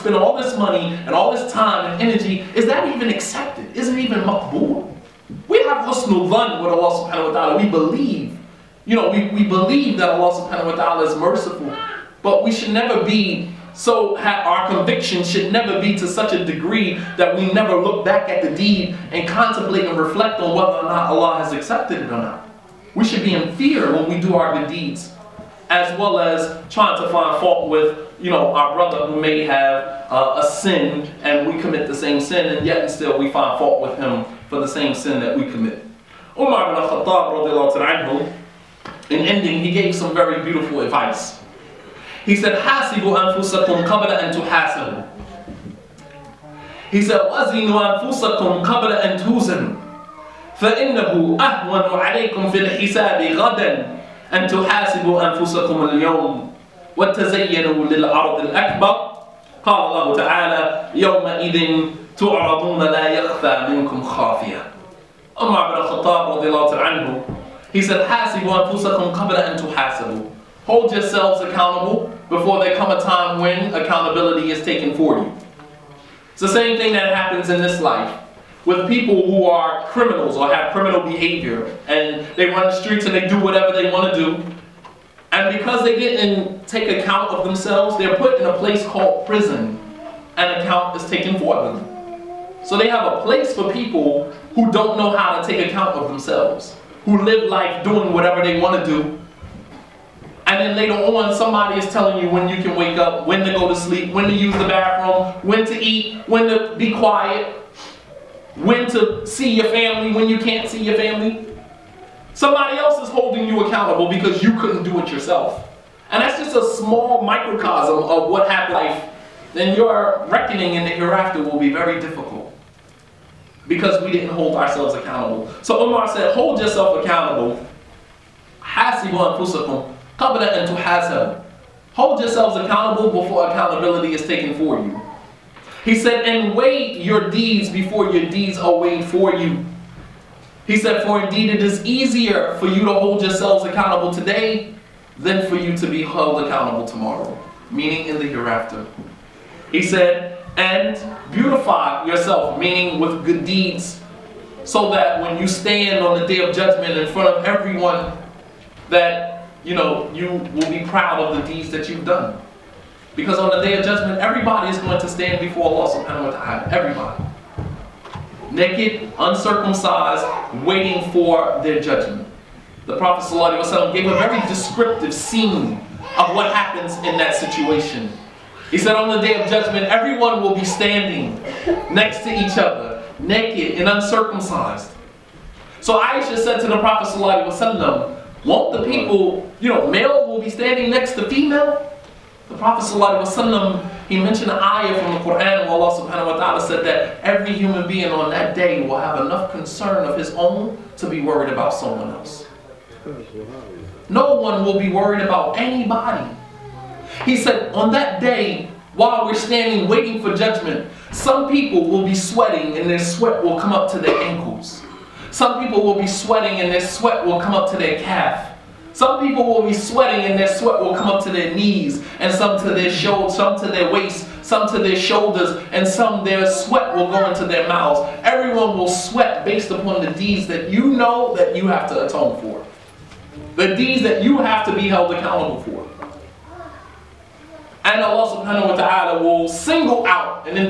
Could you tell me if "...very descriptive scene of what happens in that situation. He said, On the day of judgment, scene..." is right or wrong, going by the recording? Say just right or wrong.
wrong.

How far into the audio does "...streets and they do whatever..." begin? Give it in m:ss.
1:22.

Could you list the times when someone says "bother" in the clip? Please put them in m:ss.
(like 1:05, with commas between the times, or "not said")
not said.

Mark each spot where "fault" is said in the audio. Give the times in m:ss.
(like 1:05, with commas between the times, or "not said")
0:27, 0:33.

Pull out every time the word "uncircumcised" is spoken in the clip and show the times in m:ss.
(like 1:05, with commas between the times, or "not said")
2:49, 3:03.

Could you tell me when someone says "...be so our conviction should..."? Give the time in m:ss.
0:13.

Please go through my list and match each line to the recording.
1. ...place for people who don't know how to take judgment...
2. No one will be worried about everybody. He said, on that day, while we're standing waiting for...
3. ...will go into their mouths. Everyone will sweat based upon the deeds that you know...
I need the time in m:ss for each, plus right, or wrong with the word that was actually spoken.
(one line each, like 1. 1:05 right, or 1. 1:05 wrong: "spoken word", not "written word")
1. 1:33 wrong: "account", not "judgment"
2. 3:24 wrong: "anybody", not "everybody"
3. 3:46 right.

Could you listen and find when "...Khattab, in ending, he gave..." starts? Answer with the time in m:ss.
0:36.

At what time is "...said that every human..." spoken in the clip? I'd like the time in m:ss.
3:16.